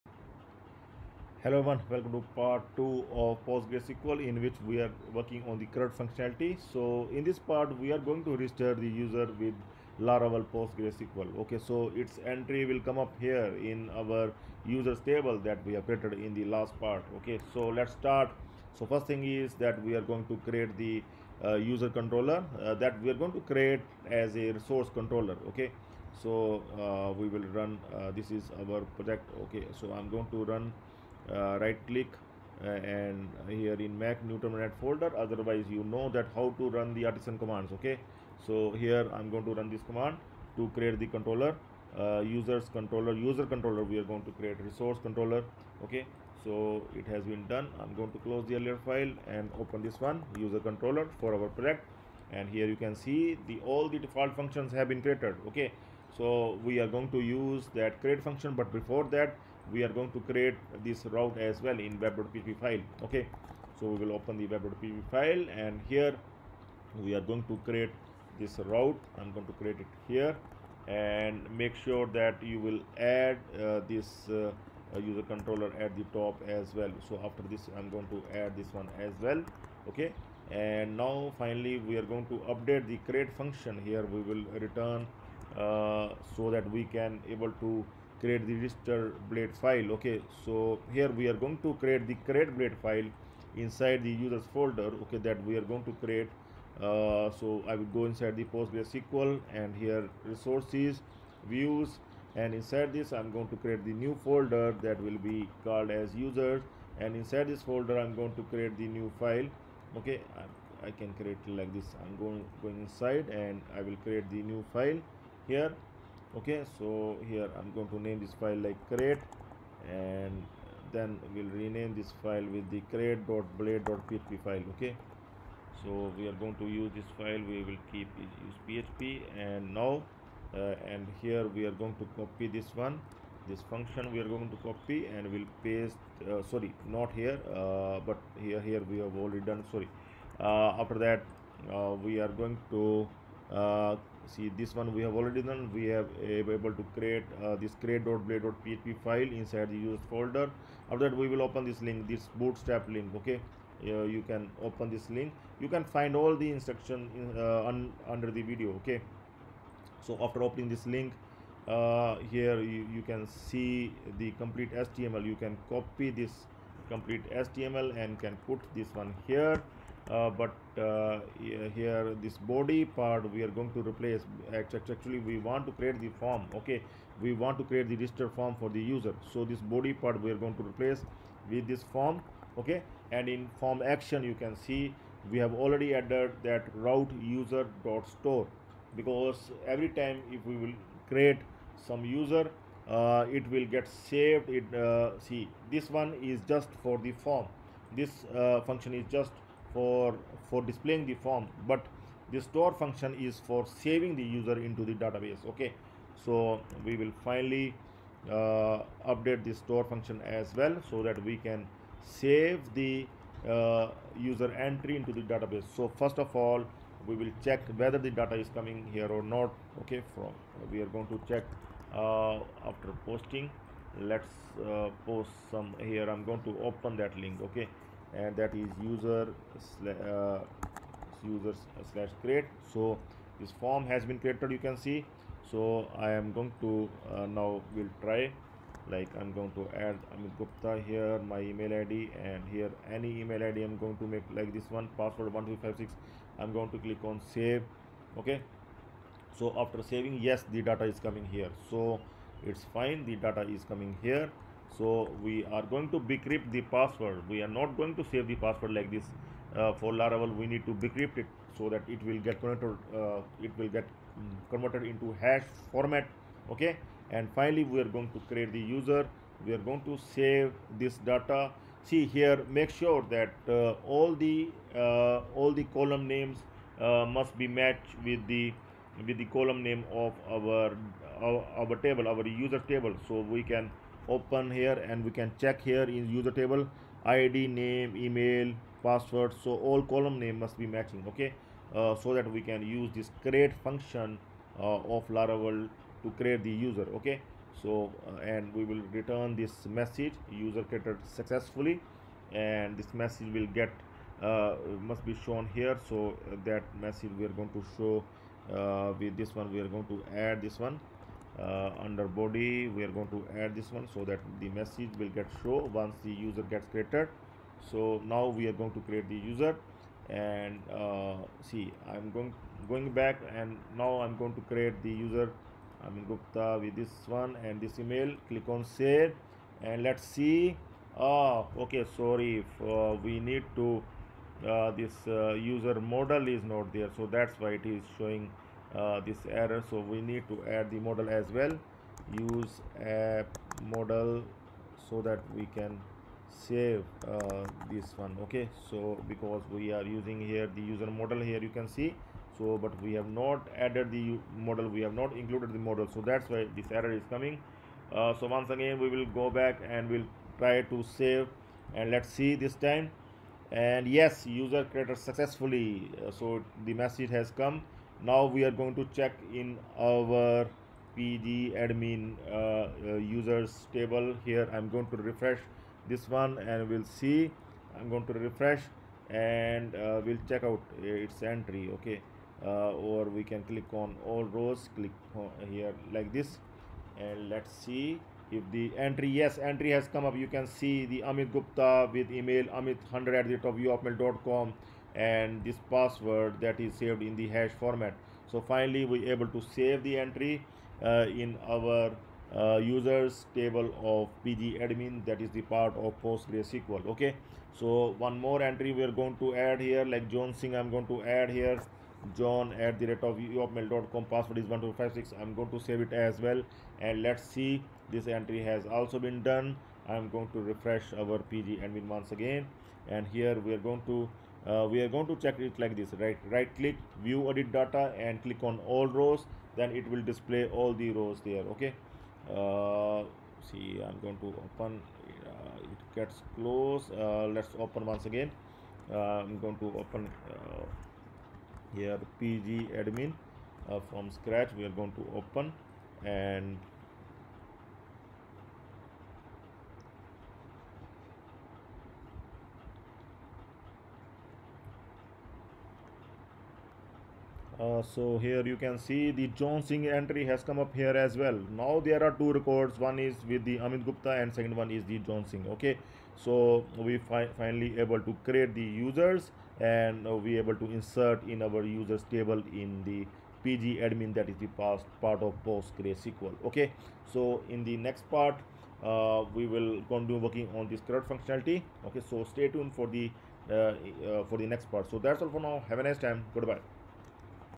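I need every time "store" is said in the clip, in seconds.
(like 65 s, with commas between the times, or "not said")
188 s, 202 s, 209 s.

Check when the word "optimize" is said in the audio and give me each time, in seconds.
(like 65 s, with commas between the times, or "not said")
not said.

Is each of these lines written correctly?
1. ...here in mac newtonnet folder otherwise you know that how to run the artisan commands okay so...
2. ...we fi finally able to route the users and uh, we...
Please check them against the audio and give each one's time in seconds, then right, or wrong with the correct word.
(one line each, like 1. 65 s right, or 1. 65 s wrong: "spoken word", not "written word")
1. 33 s right
2. 466 s wrong: "create", not "route".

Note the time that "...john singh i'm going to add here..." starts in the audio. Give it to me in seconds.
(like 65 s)
410 s.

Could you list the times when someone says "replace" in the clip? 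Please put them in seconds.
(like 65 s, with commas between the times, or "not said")
173 s, 180 s.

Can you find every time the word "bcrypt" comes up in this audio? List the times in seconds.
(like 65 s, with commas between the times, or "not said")
255 s, 260 s.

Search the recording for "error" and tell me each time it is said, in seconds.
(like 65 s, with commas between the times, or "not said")
339 s, 356 s.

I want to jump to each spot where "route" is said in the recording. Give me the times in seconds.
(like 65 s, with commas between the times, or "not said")
61 s, 68 s, 186 s.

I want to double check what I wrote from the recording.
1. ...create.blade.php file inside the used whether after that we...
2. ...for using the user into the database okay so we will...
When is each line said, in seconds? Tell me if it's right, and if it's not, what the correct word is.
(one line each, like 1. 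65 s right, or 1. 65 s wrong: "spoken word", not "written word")
1. 147 s wrong: "folder", not "whether"
2. 203 s wrong: "saving", not "using".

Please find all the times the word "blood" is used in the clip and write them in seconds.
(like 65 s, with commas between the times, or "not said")
not said.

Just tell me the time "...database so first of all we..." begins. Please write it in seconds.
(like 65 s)
215 s.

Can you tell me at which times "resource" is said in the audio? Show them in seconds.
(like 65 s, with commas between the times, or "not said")
24 s, 44 s, 100 s.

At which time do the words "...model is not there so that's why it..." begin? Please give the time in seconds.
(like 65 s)
335 s.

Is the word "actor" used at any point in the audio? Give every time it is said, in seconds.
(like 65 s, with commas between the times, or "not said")
not said.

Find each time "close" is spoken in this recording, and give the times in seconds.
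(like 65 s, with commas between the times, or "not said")
48 s, 436 s.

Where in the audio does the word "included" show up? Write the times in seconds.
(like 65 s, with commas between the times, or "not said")
355 s.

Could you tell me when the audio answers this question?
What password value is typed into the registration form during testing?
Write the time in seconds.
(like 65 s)
244 s.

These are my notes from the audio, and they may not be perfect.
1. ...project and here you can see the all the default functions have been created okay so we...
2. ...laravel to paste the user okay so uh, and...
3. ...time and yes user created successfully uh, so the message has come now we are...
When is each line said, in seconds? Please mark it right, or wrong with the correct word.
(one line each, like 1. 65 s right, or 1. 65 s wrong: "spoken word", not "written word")
1. 51 s right
2. 295 s wrong: "create", not "paste"
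3. 362 s right.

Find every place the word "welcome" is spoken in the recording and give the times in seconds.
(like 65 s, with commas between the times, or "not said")
1 s.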